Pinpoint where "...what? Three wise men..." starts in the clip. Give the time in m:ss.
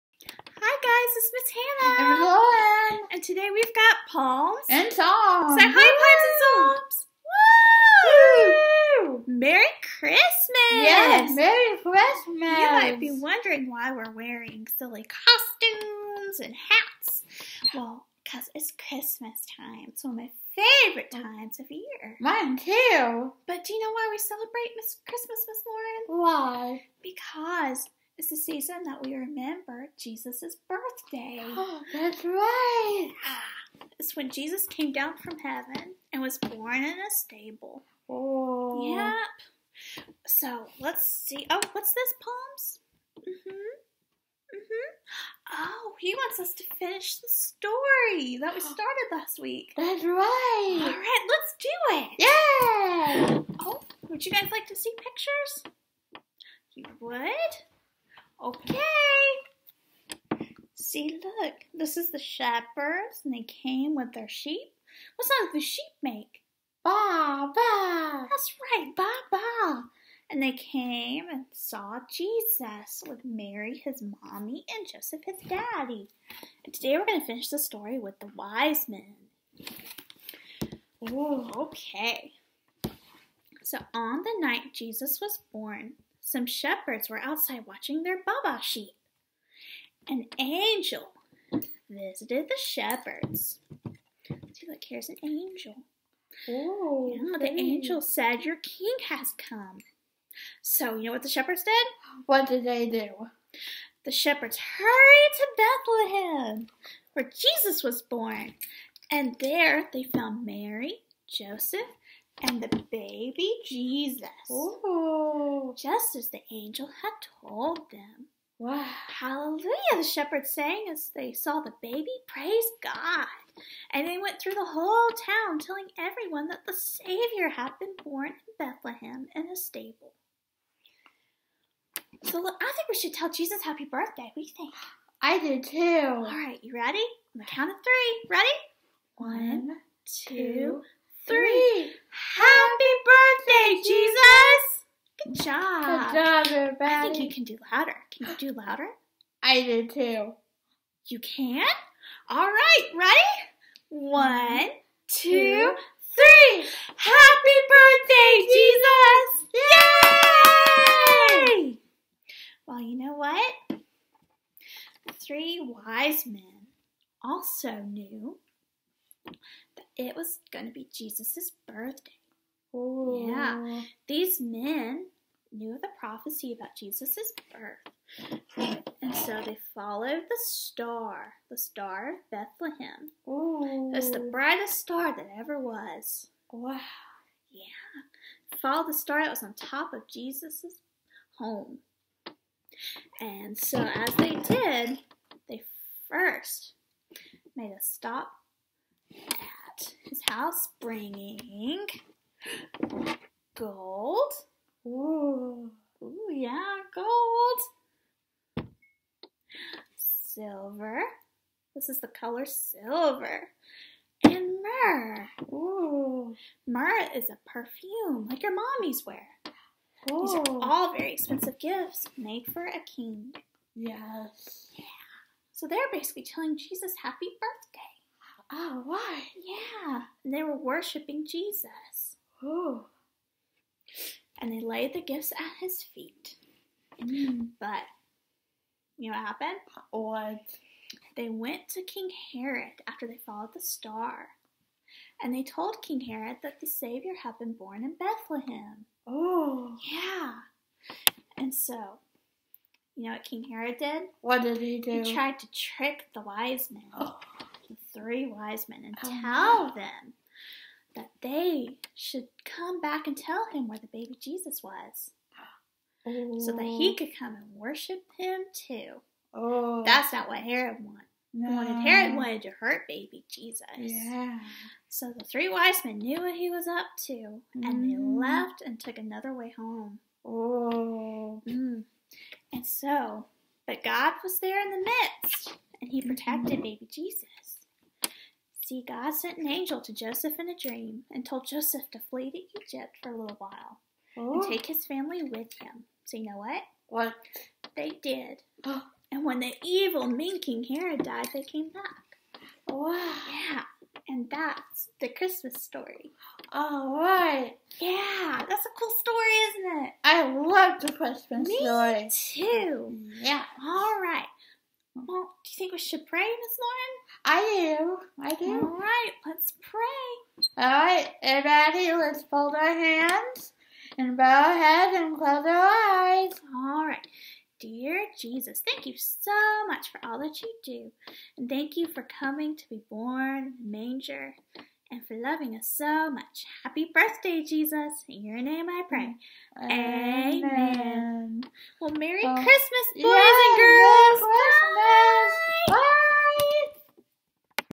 2:43.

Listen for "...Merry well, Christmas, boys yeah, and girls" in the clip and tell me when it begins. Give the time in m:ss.
5:41.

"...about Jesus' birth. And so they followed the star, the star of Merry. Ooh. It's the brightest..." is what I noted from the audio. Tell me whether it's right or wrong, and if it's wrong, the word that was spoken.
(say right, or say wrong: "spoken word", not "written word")
wrong: "Bethlehem", not "Merry".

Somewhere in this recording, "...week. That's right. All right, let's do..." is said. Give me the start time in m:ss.
0:49.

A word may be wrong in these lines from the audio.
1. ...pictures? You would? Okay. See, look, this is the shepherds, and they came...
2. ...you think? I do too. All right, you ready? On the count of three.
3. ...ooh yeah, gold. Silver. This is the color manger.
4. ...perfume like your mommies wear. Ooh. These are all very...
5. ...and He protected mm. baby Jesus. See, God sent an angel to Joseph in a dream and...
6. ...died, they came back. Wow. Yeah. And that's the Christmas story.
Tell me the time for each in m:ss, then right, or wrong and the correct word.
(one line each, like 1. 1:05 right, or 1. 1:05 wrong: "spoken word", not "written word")
1. 0:54 right
2. 2:14 right
3. 3:26 wrong: "silver", not "manger"
4. 3:37 right
5. 4:45 right
6. 5:01 right.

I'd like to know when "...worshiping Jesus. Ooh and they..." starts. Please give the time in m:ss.
3:50.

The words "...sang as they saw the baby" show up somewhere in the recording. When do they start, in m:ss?
2:00.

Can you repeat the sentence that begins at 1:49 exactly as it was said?
And there they found Mary, Joseph, and the baby Jesus, Ooh.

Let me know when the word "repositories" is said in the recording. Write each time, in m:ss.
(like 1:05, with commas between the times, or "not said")
not said.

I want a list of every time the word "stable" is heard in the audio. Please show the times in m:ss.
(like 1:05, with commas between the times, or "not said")
0:37, 2:09.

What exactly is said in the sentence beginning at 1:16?
And today we're going to finish the story with the wise men.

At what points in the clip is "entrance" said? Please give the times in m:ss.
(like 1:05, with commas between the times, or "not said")
not said.